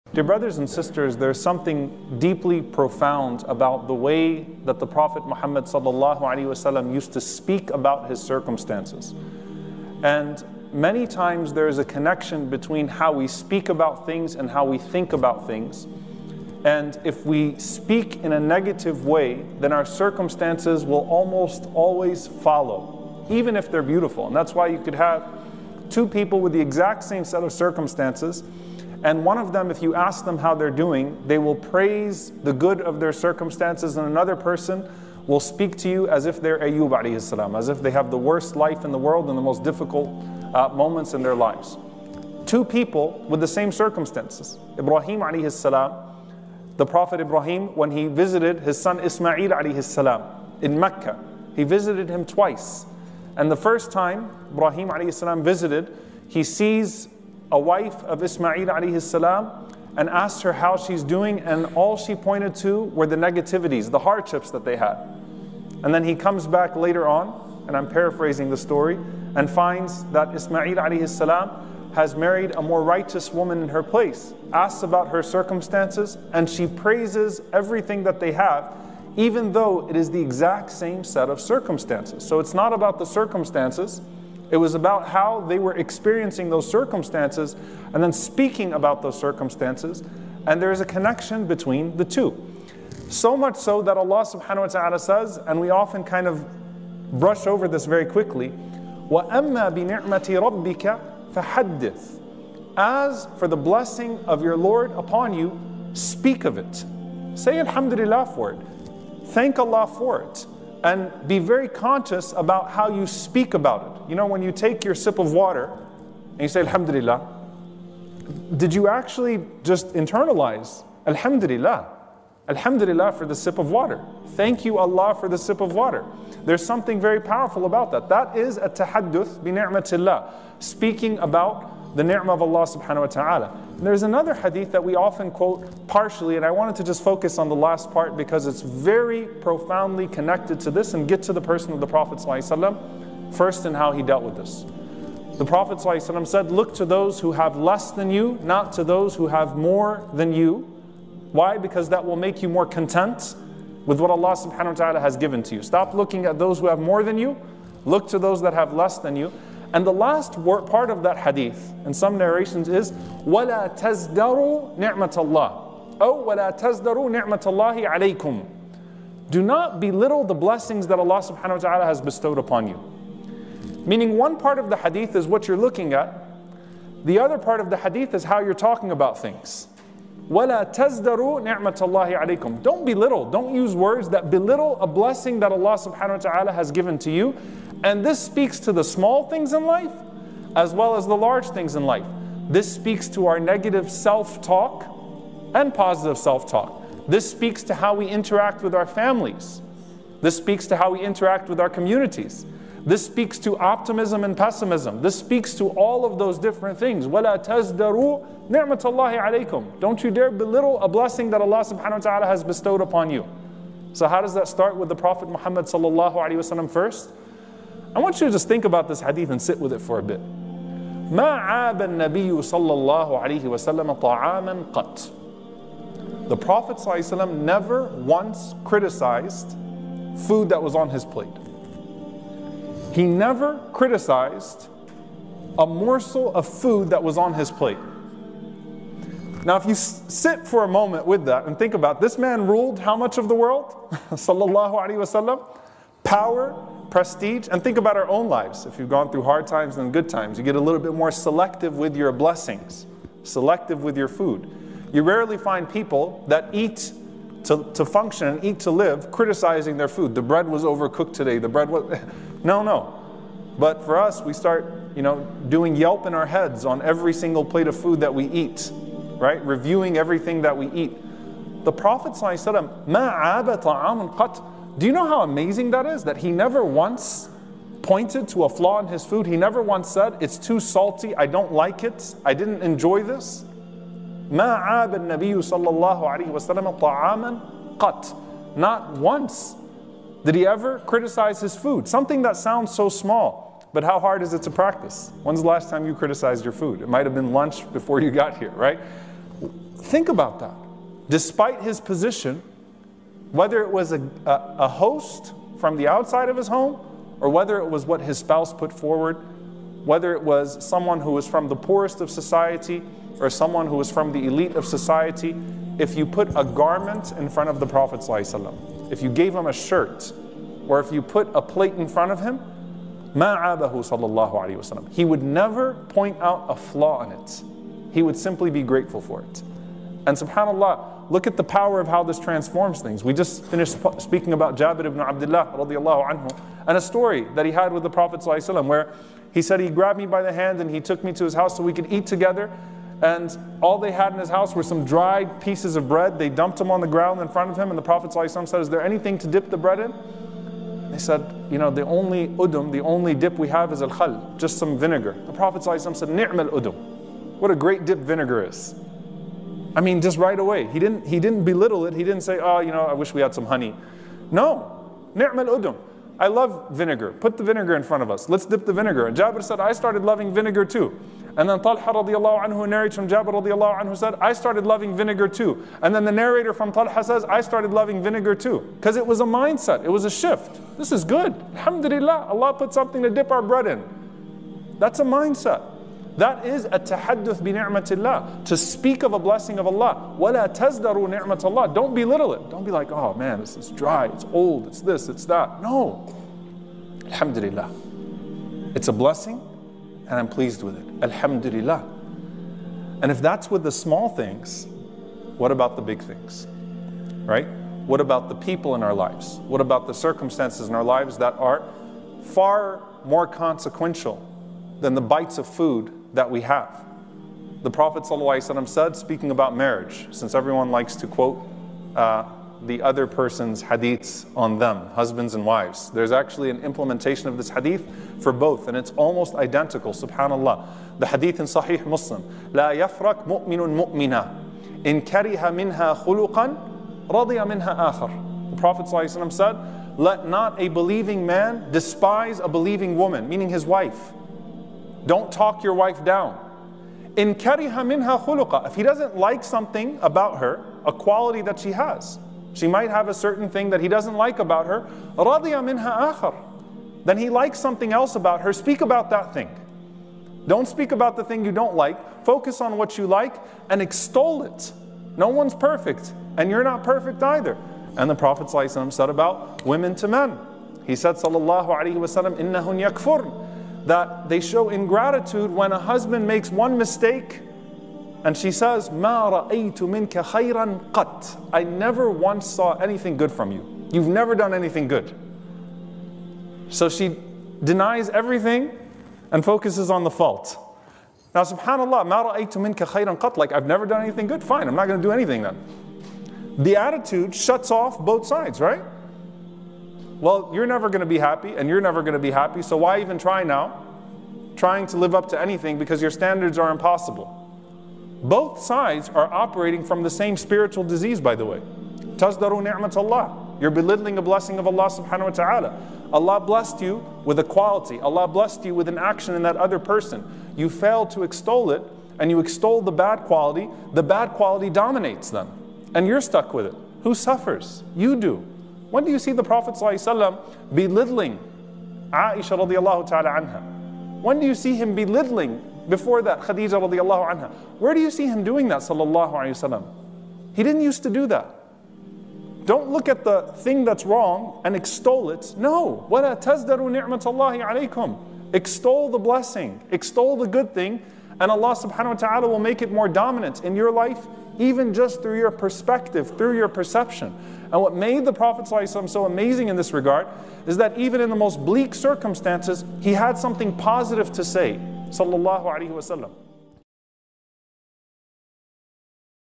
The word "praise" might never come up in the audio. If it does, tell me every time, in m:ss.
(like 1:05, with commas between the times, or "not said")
0:31, 1:16.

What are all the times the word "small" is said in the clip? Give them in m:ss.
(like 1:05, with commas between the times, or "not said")
3:08, 4:52, 6:43.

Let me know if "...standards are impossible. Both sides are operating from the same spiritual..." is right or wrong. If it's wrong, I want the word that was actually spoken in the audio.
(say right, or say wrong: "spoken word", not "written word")
right.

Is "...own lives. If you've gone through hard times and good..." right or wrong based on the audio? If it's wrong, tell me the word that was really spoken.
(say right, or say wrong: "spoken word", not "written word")
right.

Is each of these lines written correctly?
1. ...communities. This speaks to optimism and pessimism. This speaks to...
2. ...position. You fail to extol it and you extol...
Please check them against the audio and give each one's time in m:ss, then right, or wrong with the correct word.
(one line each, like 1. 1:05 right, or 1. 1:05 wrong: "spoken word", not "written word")
1. 3:21 right
2. 8:39 wrong: "person", not "position".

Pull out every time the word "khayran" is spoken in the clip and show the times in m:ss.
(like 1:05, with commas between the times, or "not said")
8:00, 8:12.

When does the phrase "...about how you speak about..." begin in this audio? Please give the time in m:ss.
1:52.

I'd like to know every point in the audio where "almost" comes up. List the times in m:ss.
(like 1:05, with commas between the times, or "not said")
0:21, 7:08.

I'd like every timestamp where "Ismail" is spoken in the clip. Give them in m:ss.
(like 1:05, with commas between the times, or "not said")
0:48, 0:58, 1:10.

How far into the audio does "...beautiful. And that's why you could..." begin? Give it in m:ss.
0:23.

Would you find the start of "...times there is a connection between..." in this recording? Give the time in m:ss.
0:11.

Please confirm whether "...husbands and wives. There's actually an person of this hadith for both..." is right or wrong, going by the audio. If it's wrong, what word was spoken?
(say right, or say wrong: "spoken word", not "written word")
wrong: "implementation", not "person".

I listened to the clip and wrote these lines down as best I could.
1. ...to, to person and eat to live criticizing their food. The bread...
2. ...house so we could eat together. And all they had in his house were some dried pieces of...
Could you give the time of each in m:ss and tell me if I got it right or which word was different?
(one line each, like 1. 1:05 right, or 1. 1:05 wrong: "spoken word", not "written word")
1. 4:17 wrong: "function", not "person"
2. 5:41 right.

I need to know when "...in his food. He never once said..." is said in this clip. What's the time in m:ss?
4:38.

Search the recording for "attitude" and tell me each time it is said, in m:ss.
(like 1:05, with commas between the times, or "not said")
8:16.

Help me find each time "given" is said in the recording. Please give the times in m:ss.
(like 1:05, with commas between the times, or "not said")
2:35, 3:06.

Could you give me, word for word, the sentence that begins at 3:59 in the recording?
Now, if you sit for a moment with that and think about this man ruled how much of the world?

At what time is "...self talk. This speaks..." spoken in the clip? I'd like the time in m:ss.
3:16.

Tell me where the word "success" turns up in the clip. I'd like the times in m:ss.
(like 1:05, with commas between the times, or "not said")
not said.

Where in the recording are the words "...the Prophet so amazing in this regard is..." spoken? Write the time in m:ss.
9:18.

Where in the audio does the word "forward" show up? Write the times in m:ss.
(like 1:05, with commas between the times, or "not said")
5:08.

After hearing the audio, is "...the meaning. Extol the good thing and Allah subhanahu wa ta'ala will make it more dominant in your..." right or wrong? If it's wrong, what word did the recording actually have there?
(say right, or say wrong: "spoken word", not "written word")
wrong: "blessing", not "meaning".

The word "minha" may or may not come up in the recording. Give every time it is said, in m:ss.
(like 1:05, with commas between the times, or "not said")
7:27, 7:35.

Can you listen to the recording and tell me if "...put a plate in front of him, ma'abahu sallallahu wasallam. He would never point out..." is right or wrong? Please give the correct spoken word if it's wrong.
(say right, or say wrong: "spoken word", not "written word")
right.